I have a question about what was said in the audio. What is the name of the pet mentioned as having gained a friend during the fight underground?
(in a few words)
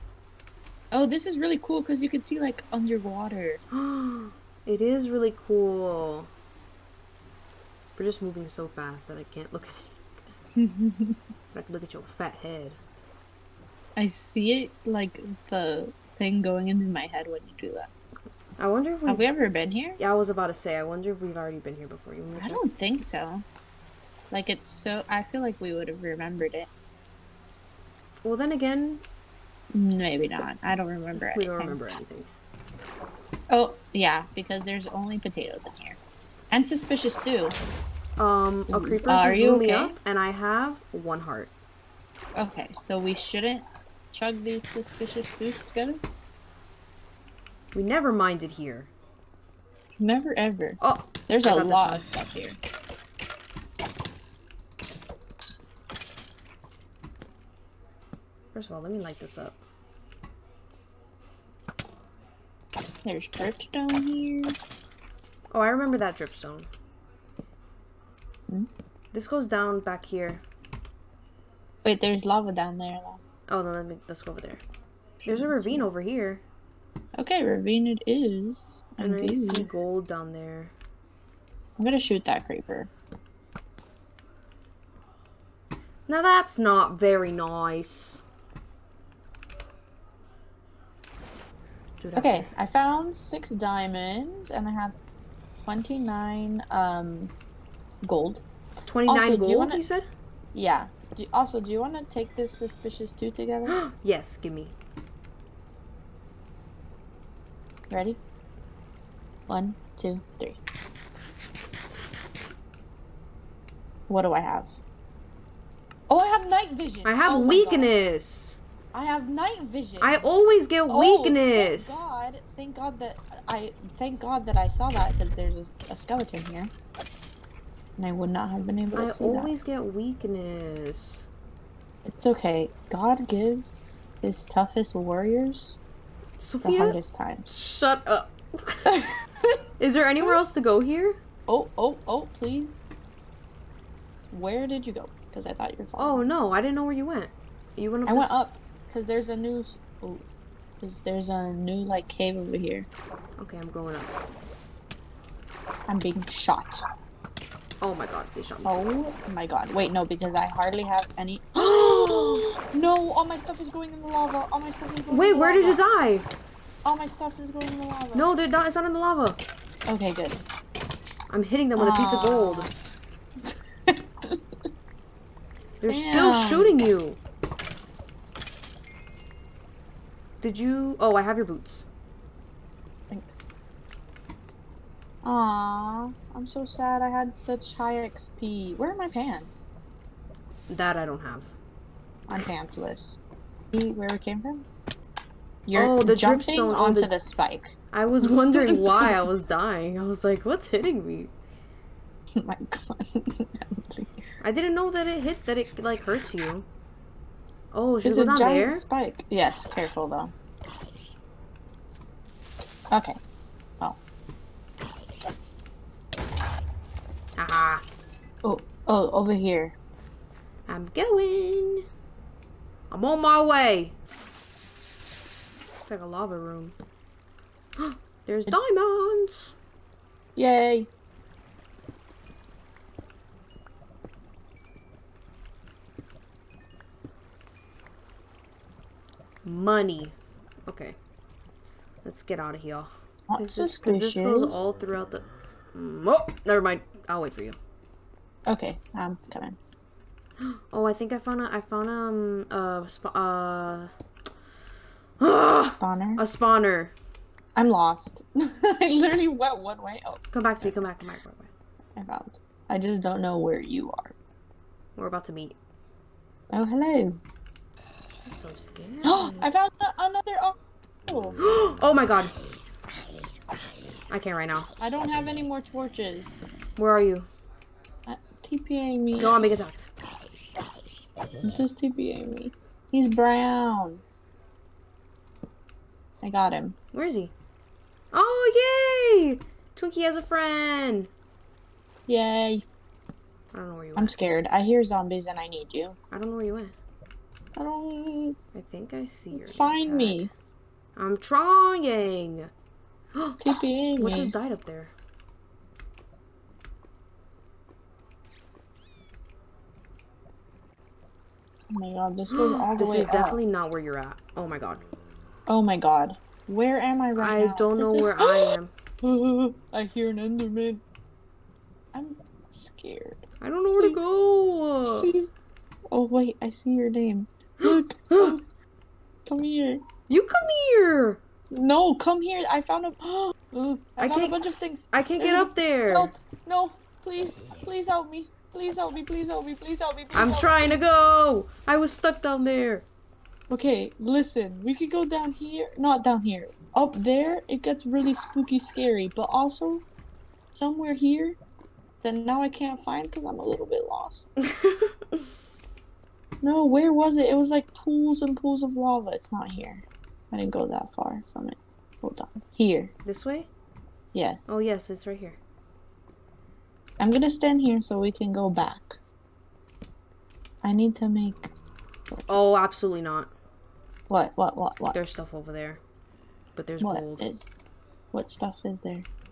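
Twinkie.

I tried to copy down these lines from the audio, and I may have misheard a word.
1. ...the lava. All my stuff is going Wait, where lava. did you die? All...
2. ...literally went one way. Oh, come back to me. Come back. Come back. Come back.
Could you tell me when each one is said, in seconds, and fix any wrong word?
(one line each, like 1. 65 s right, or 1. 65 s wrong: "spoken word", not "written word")
1. 164 s right
2. 258 s right.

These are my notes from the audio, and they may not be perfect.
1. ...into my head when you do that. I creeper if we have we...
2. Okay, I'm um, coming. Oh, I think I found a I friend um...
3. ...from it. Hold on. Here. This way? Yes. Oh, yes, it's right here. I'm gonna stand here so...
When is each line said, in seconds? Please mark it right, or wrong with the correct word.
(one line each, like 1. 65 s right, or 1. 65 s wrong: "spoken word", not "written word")
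1. 16 s wrong: "wonder", not "creeper"
2. 248 s wrong: "found", not "friend"
3. 361 s right.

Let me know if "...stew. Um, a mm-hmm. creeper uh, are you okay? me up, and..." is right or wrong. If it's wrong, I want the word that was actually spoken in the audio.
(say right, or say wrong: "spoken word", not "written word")
right.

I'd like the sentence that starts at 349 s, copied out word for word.
But also, somewhere here that now I can't find because I'm a little bit lost.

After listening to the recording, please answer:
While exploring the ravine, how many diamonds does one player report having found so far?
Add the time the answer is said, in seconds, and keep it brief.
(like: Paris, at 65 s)
6, at 93 s.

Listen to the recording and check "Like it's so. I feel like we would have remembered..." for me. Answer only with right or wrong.
right.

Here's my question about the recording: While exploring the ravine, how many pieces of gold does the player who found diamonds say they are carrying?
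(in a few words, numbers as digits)
29.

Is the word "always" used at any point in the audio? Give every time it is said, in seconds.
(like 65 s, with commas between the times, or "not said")
120 s, 129 s.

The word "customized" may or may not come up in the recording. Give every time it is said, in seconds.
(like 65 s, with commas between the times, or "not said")
not said.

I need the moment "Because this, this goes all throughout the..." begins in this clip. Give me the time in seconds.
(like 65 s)
243 s.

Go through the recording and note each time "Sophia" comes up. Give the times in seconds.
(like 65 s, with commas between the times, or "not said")
136 s.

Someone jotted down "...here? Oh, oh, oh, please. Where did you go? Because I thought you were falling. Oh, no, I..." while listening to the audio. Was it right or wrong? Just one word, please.
right.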